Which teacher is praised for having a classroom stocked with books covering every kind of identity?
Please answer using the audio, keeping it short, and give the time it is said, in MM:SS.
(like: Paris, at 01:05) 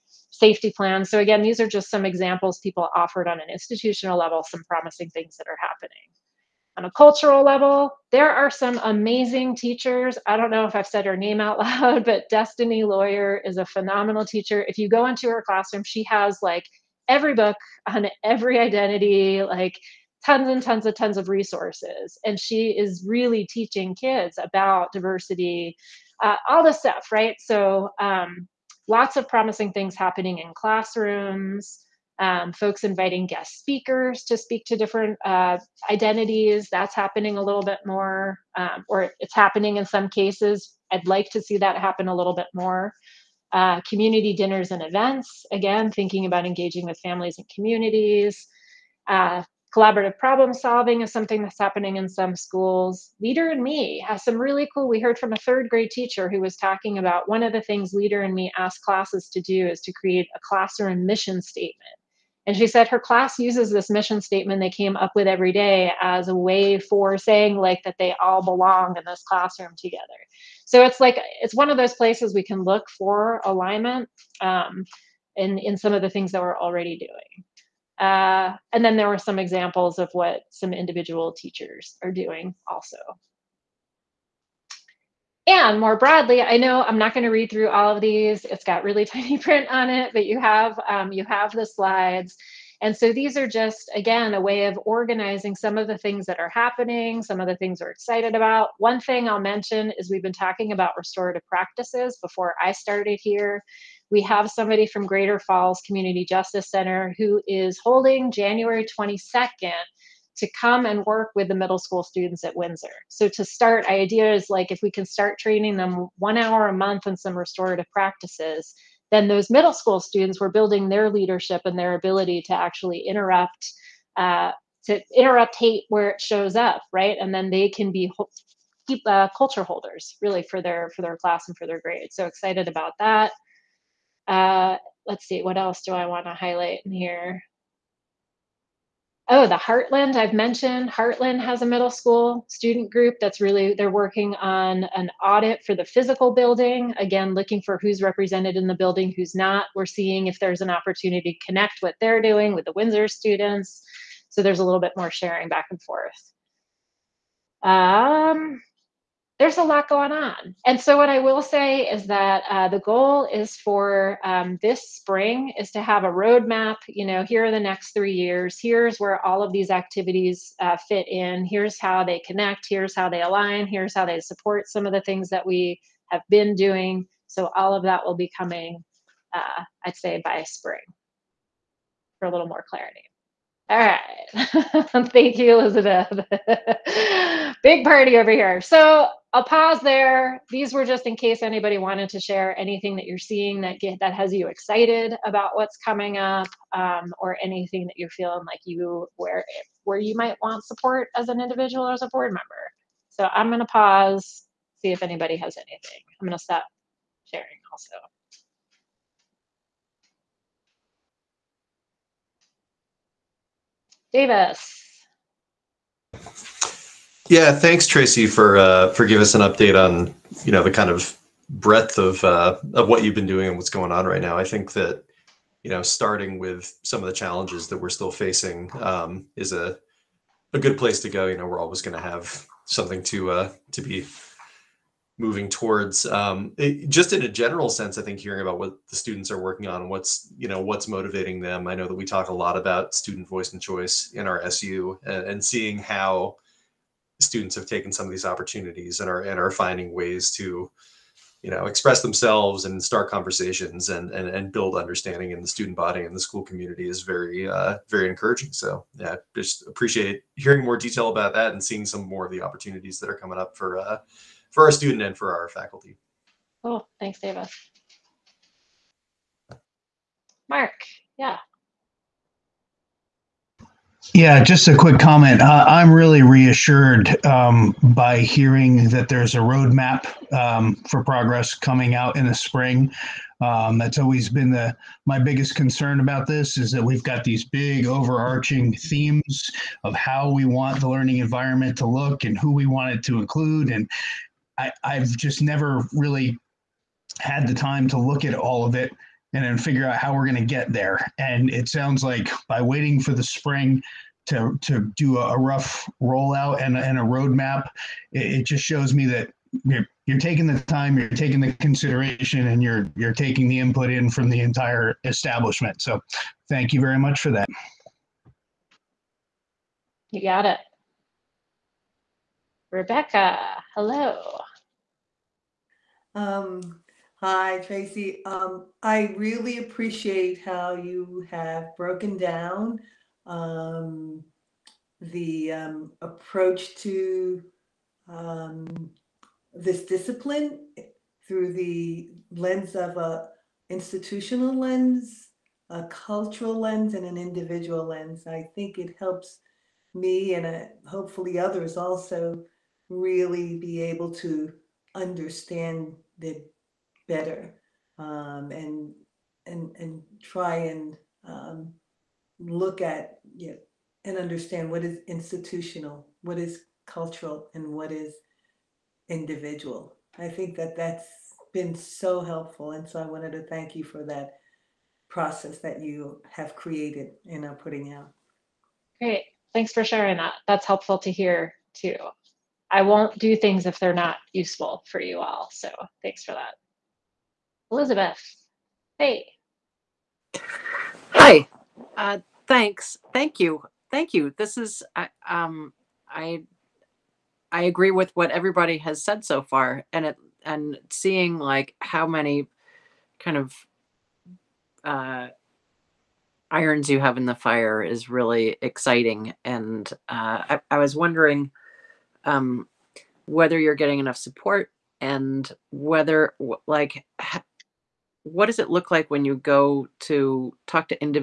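Destiny Lawyer, at 00:12.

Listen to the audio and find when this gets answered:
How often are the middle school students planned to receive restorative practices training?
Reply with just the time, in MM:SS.
01:56.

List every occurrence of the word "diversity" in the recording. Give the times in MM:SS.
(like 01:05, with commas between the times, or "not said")
00:24.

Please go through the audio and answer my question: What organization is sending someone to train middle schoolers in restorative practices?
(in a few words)
Greater Falls Community Justice Center.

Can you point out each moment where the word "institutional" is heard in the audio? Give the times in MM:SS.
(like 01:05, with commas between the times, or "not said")
00:03, 05:43, 06:05.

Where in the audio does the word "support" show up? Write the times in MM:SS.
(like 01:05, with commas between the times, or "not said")
02:54, 03:20, 06:54.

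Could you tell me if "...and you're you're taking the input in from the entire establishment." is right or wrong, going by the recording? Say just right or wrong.
right.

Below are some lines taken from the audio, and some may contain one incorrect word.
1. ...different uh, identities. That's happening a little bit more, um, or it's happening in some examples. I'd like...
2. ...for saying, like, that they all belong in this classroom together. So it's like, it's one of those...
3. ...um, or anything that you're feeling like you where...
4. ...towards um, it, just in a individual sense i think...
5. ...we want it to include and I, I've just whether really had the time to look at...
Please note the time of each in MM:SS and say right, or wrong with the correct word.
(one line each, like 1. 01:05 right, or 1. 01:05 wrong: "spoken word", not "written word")
1. 00:34 wrong: "cases", not "examples"
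2. 01:06 right
3. 03:16 right
4. 03:55 wrong: "general", not "individual"
5. 04:52 wrong: "never", not "whether".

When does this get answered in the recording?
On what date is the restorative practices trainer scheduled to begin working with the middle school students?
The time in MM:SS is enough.
01:48.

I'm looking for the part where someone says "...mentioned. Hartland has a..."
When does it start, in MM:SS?
02:20.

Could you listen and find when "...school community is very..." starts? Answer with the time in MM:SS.
04:16.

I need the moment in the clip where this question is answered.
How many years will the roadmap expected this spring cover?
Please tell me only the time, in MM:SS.
02:47.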